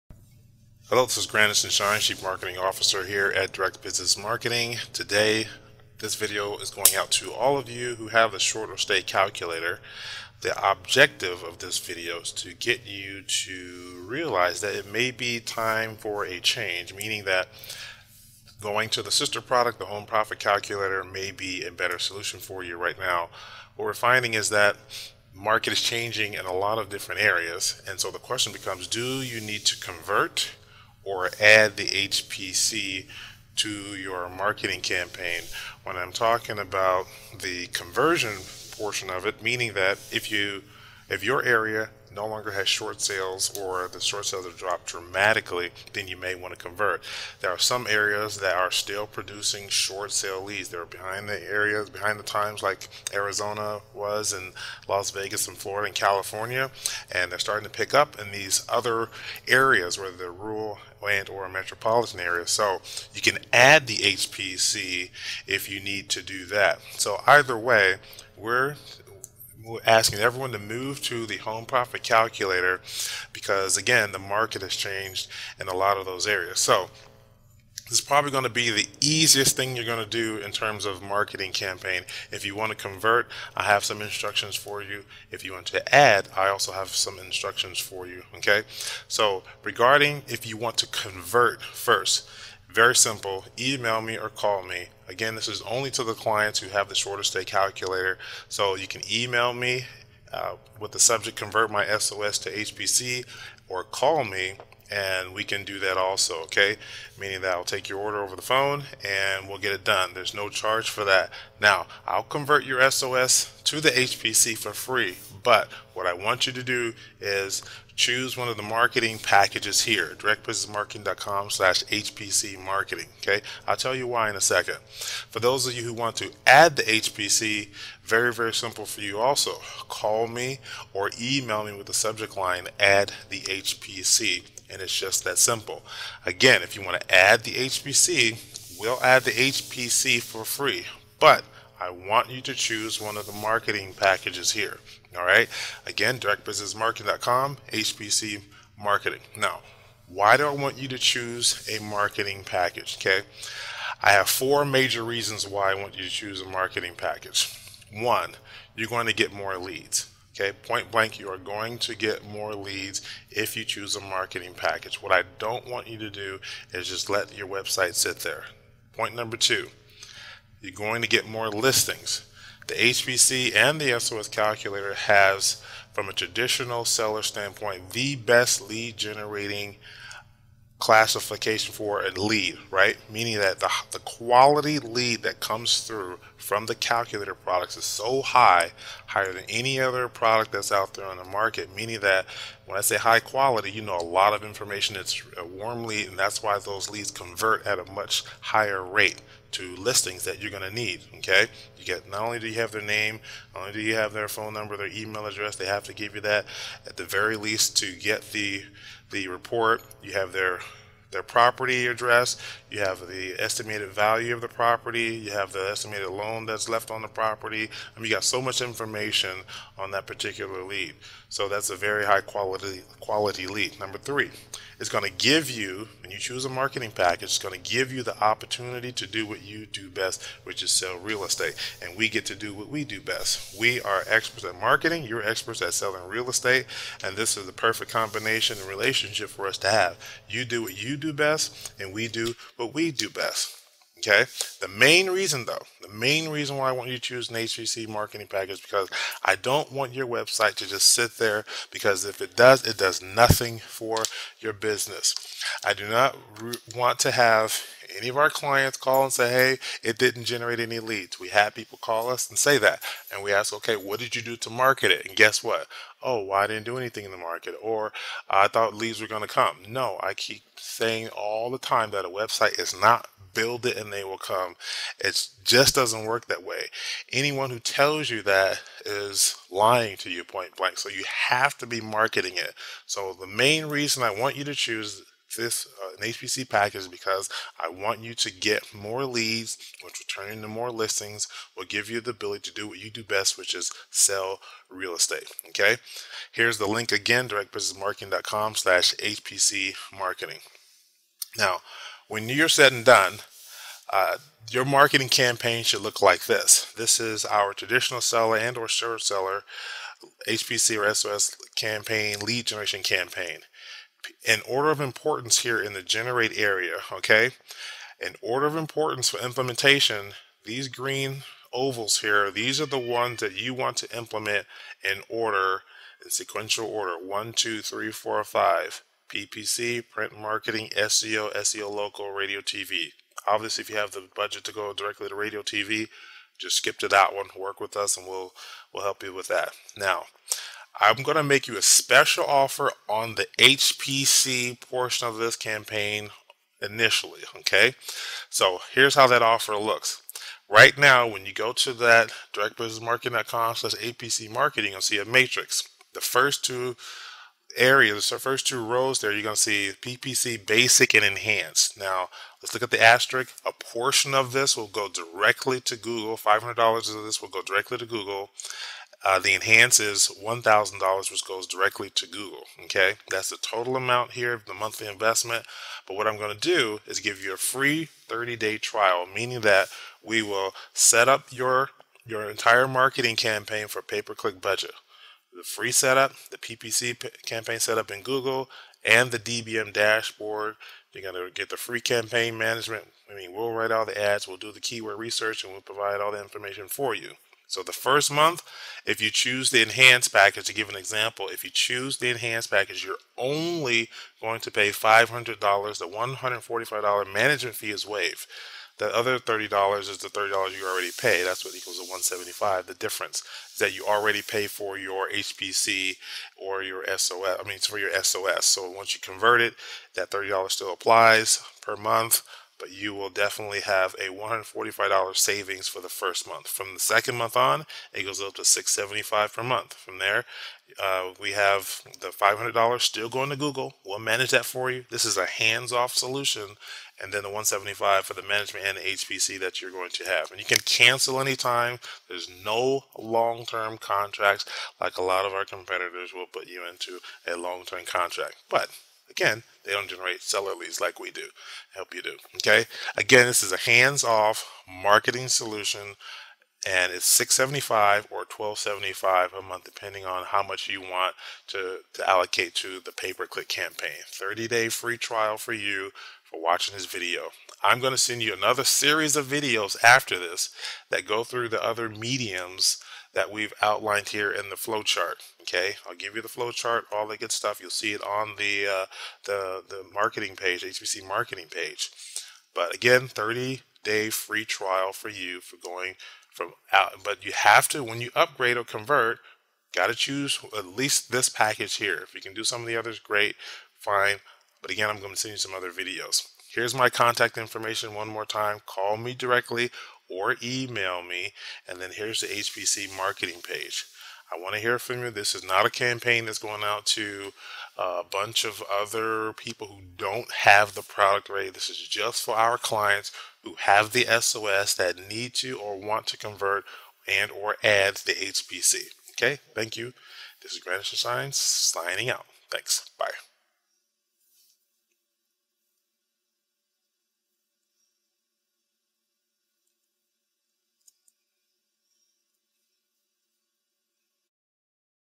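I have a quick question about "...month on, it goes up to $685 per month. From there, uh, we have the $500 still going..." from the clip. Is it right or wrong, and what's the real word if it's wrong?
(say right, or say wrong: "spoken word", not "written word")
wrong: "675", not "685".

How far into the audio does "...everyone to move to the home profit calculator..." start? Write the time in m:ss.
1:10.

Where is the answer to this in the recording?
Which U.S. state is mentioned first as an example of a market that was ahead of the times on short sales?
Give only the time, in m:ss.
0:53.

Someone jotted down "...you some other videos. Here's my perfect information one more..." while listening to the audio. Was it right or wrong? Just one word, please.
wrong.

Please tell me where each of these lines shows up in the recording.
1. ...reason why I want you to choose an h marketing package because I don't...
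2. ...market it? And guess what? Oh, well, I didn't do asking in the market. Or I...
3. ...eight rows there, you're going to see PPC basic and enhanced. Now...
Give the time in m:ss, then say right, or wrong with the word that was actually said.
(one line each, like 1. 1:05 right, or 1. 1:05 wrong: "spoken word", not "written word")
1. 4:06 right
2. 4:24 wrong: "anything", not "asking"
3. 5:58 wrong: "two", not "eight".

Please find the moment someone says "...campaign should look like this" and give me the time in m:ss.
5:05.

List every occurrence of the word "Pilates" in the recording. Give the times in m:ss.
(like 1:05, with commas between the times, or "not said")
not said.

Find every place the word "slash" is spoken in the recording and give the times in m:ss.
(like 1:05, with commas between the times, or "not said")
2:01, 4:57, 5:53.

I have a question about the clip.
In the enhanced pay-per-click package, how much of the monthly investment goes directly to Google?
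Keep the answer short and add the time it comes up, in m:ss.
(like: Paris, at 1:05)
$1,000, at 6:10.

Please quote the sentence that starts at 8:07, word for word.
But you have to when you upgrade or convert, got to choose at least this package here.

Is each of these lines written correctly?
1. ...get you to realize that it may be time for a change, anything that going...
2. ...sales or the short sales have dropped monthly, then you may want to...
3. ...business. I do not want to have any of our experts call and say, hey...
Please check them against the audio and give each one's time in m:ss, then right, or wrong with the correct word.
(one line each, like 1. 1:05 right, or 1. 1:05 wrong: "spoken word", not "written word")
1. 0:12 wrong: "meaning", not "anything"
2. 0:43 wrong: "dramatically", not "monthly"
3. 4:14 wrong: "clients", not "experts".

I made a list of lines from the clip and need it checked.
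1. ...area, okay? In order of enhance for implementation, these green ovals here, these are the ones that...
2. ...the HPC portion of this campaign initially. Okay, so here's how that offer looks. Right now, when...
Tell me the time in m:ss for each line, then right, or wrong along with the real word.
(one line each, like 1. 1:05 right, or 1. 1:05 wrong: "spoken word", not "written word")
1. 5:16 wrong: "importance", not "enhance"
2. 5:43 right.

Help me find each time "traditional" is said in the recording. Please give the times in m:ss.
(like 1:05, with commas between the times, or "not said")
2:56, 5:07.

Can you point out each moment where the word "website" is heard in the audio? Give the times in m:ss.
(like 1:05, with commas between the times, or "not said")
2:47, 4:10, 4:32.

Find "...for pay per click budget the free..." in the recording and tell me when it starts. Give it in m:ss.
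6:23.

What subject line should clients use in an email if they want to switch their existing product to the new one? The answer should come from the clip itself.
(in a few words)
convert my SOS to HPC.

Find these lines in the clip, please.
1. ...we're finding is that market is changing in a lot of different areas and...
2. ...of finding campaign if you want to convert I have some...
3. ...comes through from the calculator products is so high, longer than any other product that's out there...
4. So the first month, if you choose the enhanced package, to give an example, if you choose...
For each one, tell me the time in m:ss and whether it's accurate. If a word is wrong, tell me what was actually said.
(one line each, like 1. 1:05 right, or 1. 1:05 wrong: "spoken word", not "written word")
1. 0:23 right
2. 1:20 wrong: "marketing", not "finding"
3. 3:05 wrong: "higher", not "longer"
4. 6:37 right.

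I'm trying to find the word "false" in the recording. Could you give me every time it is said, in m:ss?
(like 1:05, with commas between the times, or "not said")
not said.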